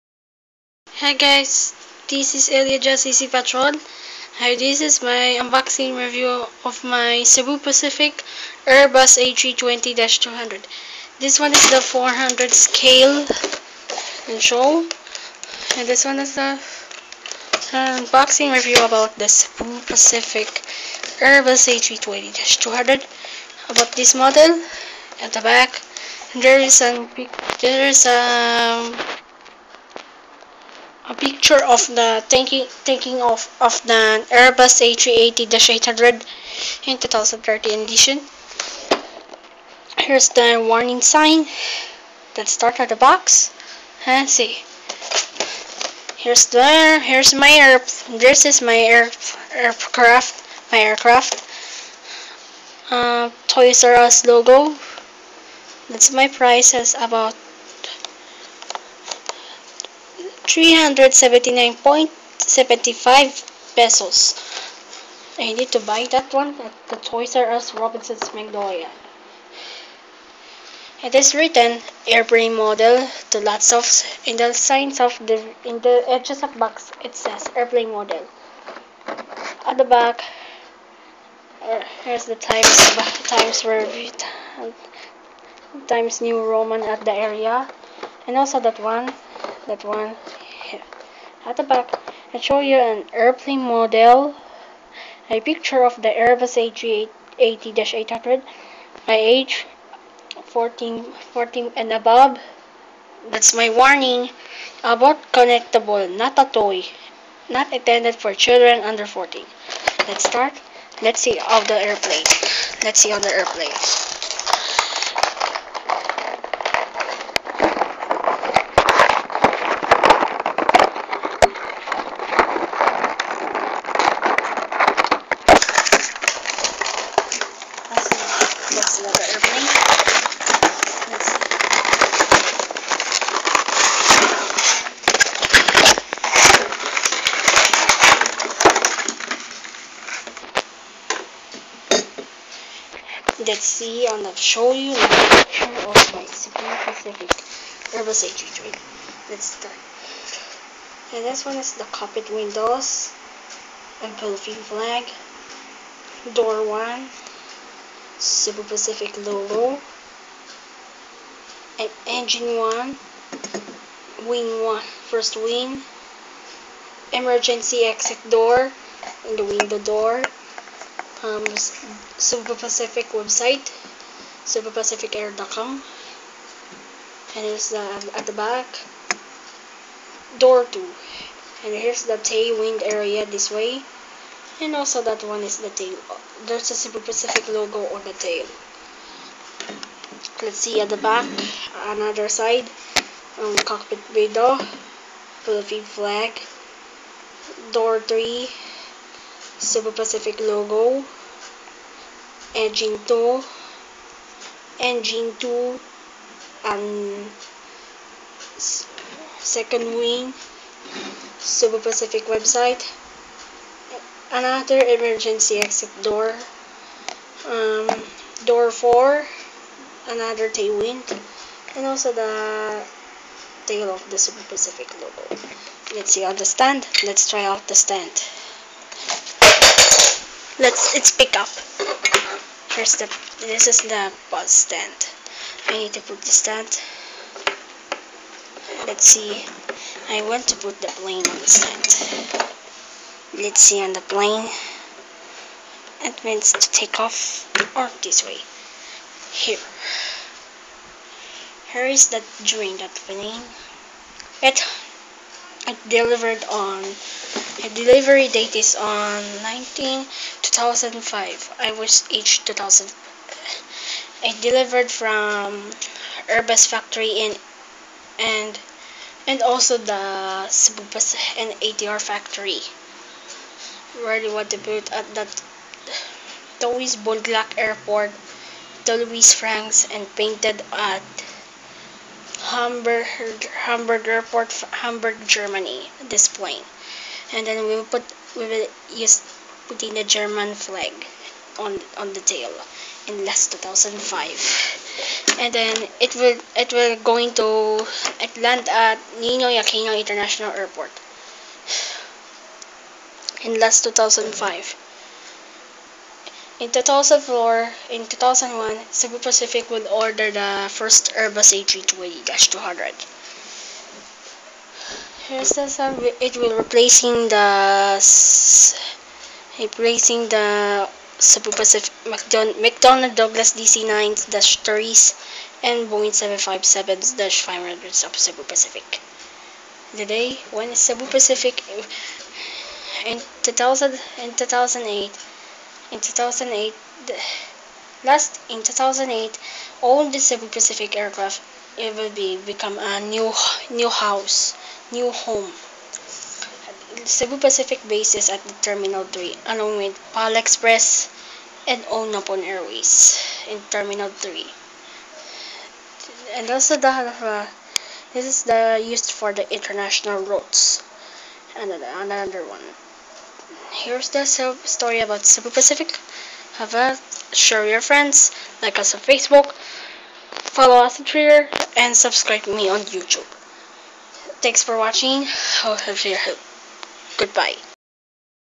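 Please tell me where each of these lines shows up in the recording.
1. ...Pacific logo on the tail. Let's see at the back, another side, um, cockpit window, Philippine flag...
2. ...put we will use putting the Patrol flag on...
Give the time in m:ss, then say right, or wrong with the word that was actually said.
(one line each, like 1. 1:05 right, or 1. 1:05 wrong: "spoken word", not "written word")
1. 3:06 right
2. 4:47 wrong: "German", not "Patrol".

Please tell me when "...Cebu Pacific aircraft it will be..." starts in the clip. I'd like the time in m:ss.
5:40.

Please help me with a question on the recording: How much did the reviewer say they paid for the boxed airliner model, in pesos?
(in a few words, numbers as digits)
379.75.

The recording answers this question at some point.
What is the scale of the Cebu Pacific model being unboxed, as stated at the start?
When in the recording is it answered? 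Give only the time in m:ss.
0:11.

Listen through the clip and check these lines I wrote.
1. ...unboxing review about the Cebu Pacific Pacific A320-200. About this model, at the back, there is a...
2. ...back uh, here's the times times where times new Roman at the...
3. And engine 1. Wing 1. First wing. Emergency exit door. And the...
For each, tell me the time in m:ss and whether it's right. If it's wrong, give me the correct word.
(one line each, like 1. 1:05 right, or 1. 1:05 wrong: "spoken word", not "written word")
1. 0:17 wrong: "Airbus", not "Pacific"
2. 1:19 right
3. 2:41 right.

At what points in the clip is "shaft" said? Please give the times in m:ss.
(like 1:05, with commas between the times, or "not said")
not said.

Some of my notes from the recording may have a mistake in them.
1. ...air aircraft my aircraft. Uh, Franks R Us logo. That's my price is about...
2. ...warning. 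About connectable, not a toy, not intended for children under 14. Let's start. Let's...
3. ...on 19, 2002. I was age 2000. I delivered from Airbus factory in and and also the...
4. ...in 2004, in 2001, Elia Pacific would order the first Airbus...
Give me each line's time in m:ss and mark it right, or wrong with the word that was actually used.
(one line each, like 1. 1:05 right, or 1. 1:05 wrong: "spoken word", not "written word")
1. 0:48 wrong: "Toys", not "Franks"
2. 1:43 right
3. 4:18 wrong: "2005", not "2002"
4. 5:06 wrong: "Cebu", not "Elia".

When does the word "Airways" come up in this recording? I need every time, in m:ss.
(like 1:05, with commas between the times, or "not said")
5:52.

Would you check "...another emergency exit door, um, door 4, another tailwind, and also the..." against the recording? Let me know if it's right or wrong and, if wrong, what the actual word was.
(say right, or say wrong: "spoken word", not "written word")
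right.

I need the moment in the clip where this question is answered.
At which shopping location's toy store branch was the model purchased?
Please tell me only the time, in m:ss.
1:07.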